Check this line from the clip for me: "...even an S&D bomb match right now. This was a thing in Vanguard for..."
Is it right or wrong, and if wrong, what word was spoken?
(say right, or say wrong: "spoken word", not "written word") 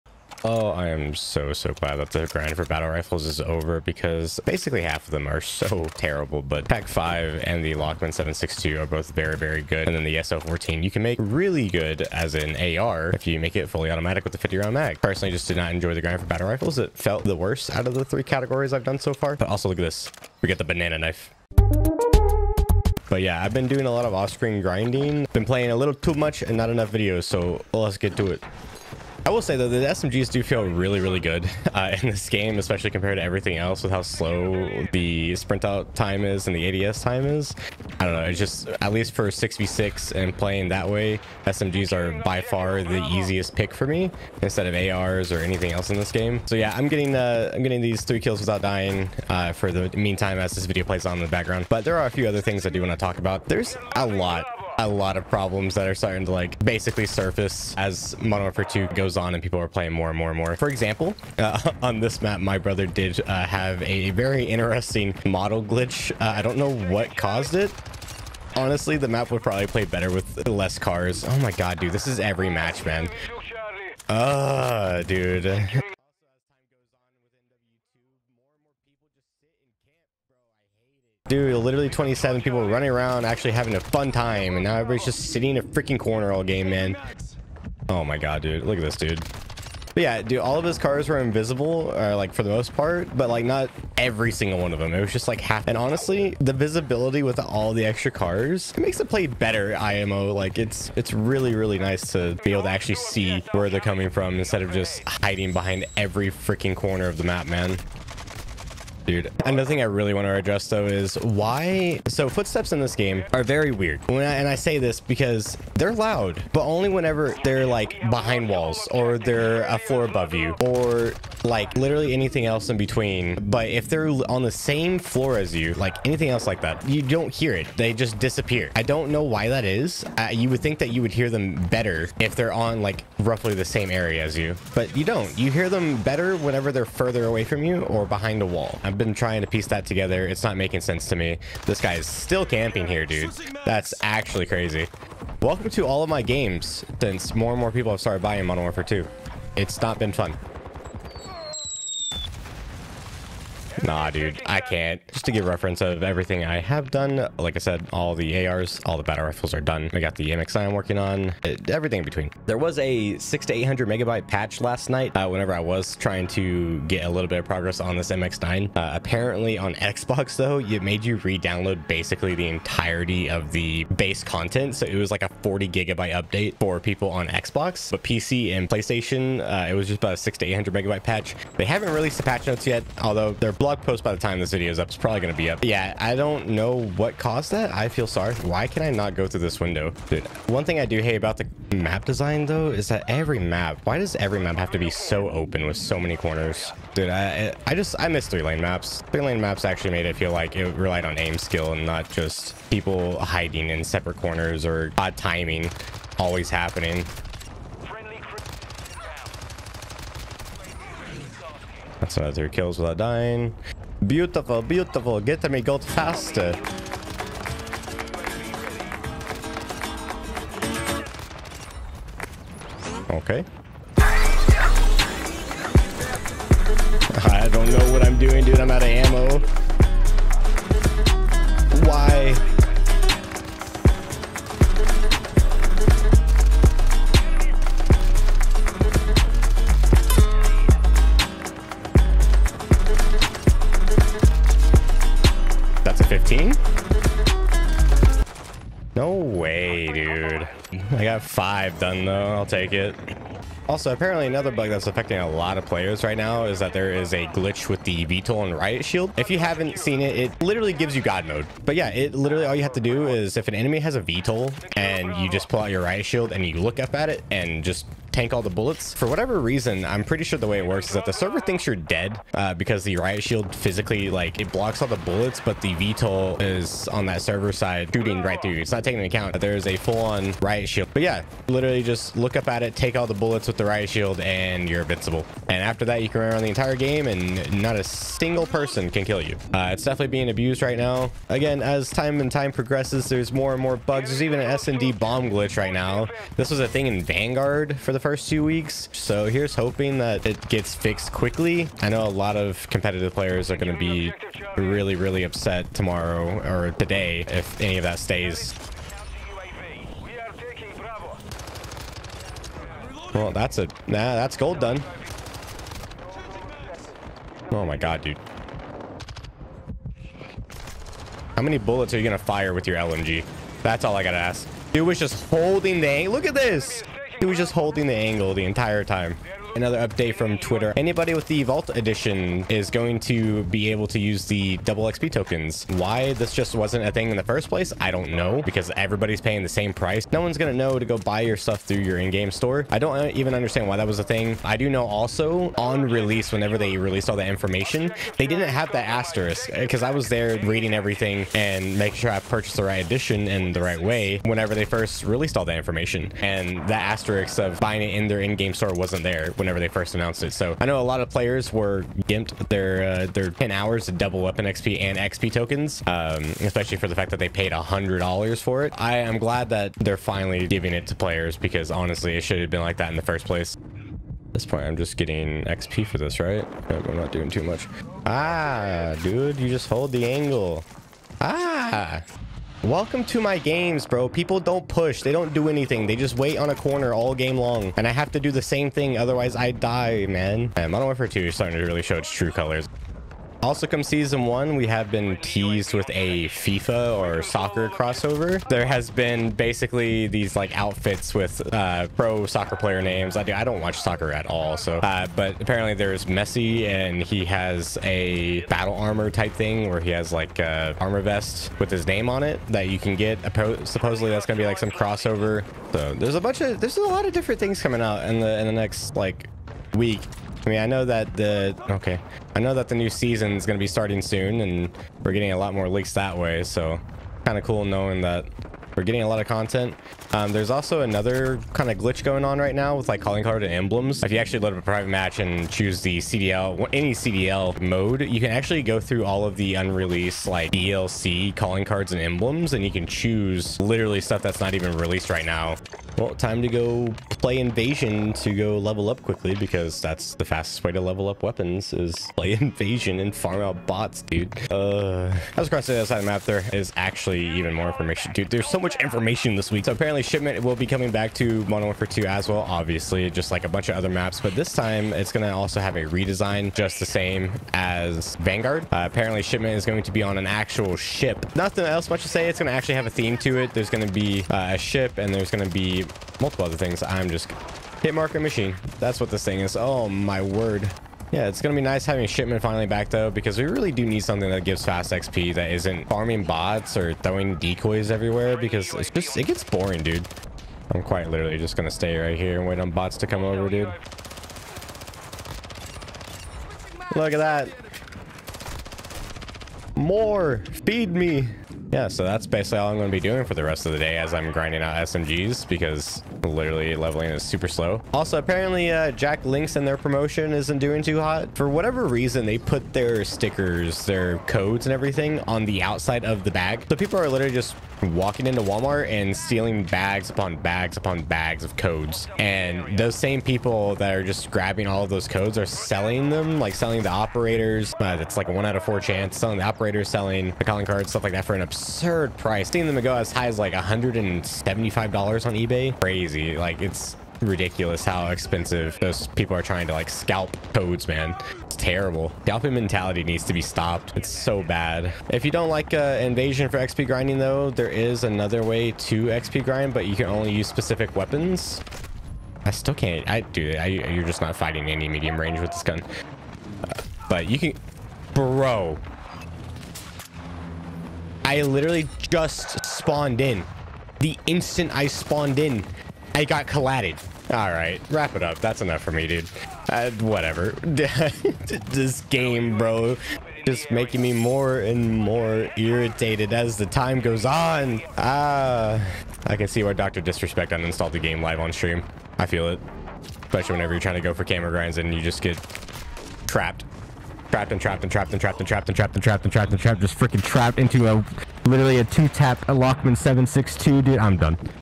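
wrong: "glitch", not "match".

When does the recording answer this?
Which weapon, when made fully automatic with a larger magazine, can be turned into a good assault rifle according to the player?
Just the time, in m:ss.
0:10.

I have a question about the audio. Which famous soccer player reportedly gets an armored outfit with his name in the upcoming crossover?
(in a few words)
Messi.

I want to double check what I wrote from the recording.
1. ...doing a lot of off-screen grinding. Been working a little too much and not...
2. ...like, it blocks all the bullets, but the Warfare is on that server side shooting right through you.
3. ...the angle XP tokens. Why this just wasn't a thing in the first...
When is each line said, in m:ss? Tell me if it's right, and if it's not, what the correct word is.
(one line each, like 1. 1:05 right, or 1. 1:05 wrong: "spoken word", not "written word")
1. 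0:23 wrong: "playing", not "working"
2. 4:34 wrong: "VTOL", not "Warfare"
3. 5:34 wrong: "double", not "angle".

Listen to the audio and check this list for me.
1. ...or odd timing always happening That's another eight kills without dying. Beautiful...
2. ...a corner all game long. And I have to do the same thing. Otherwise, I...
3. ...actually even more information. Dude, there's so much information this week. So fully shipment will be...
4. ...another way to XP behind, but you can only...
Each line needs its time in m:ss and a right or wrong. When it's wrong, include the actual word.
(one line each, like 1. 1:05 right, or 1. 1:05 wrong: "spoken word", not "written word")
1. 3:24 wrong: "three", not "eight"
2. 6:26 right
3. 7:36 wrong: "apparently", not "fully"
4. 9:08 wrong: "grind", not "behind".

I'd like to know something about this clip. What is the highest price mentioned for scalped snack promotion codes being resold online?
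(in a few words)
$175.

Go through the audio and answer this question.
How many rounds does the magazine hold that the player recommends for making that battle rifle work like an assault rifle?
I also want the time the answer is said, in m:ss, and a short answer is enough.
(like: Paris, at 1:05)
50, at 0:14.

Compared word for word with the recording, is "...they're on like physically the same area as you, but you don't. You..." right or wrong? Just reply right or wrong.
wrong.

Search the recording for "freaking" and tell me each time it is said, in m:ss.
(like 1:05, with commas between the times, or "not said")
1:25, 1:46, 9:49.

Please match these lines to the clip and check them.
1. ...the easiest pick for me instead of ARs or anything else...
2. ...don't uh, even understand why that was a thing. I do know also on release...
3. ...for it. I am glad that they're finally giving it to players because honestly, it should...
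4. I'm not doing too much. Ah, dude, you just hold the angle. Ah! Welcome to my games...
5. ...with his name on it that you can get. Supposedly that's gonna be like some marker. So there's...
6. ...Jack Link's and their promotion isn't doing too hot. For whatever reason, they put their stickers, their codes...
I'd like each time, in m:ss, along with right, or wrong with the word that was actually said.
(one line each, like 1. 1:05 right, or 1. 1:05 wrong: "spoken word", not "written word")
1. 0:42 right
2. 5:42 right
3. 6:08 right
4. 6:16 right
5. 6:51 wrong: "crossover", not "marker"
6. 8:28 right.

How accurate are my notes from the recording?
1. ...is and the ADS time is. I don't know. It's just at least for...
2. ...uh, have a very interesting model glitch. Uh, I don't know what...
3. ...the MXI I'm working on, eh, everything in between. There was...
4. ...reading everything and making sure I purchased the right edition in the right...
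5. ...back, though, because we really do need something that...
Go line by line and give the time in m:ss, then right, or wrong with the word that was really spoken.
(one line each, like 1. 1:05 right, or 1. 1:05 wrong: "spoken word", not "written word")
1. 0:36 right
2. 1:03 right
3. 2:40 right
4. 5:50 right
5. 8:02 right.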